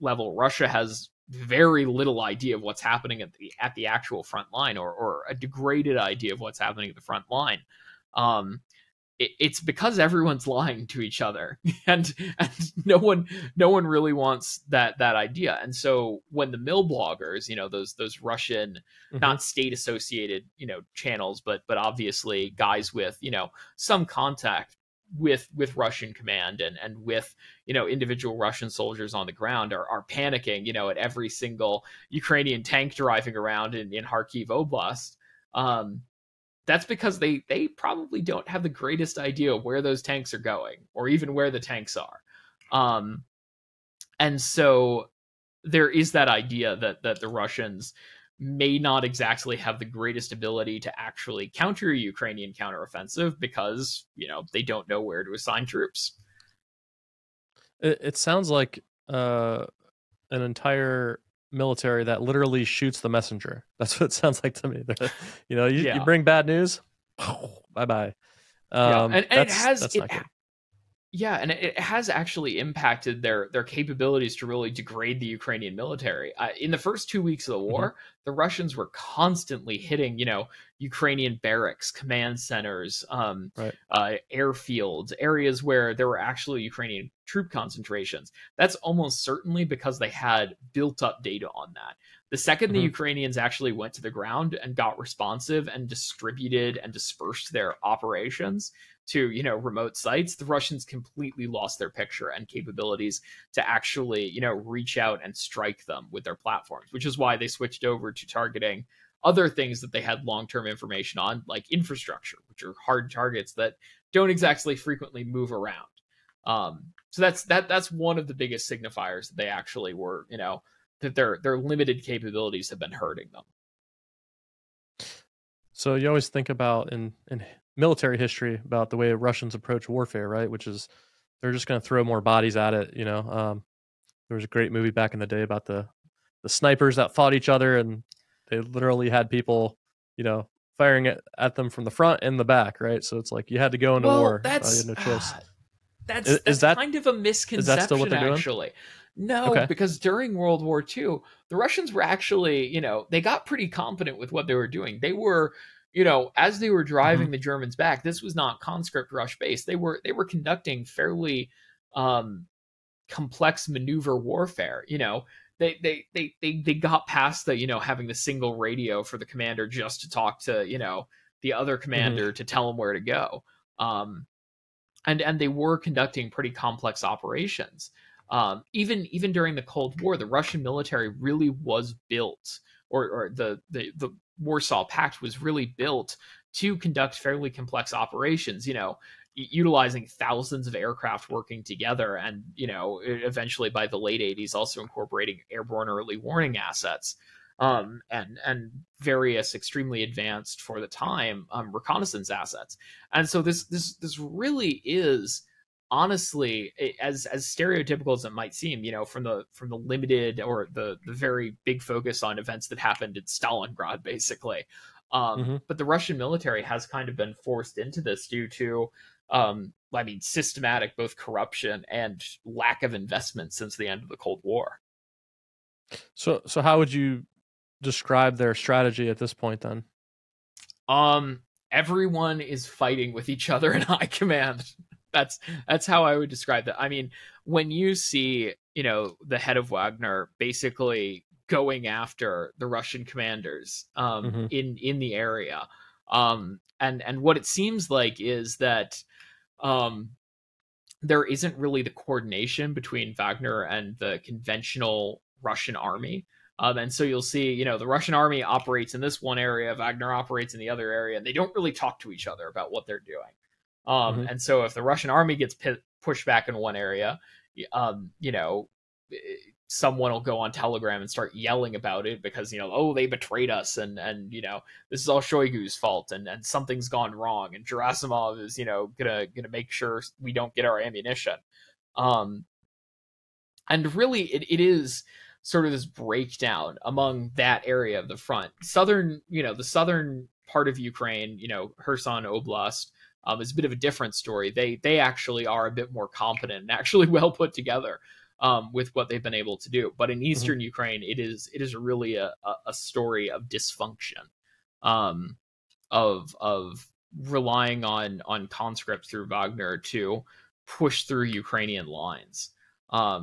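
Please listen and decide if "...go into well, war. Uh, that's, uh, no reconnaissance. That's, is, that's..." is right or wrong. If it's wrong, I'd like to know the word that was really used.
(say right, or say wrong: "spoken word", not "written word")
wrong: "choice", not "reconnaissance".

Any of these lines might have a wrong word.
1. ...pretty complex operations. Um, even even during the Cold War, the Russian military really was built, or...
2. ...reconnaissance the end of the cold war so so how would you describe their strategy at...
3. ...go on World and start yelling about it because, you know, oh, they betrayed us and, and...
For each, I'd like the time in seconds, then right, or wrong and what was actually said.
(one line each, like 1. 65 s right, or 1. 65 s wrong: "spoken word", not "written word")
1. 176 s right
2. 223 s wrong: "since", not "reconnaissance"
3. 270 s wrong: "Telegram", not "World".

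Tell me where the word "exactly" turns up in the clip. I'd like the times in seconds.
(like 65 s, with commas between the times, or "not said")
49 s, 114 s.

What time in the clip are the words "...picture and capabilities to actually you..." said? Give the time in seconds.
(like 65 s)
101 s.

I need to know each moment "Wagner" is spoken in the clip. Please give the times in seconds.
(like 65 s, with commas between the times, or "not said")
239 s, 253 s, 259 s, 309 s.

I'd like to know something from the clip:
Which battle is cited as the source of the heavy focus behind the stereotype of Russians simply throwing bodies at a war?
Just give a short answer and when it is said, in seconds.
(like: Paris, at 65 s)
Stalingrad, at 213 s.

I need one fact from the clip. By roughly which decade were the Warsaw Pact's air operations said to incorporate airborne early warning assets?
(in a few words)
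Late 80s.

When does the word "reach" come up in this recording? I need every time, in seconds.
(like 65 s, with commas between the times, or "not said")
104 s.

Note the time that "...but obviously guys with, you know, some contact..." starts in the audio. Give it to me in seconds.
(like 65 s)
21 s.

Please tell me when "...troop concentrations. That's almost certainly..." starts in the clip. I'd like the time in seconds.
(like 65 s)
87 s.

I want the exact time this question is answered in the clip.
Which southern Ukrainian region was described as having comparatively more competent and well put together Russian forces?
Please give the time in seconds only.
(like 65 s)
291 s.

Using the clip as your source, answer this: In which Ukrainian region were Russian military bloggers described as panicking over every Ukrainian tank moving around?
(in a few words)
Kharkiv Oblast.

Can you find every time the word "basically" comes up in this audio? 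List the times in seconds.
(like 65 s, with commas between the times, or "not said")
214 s, 240 s.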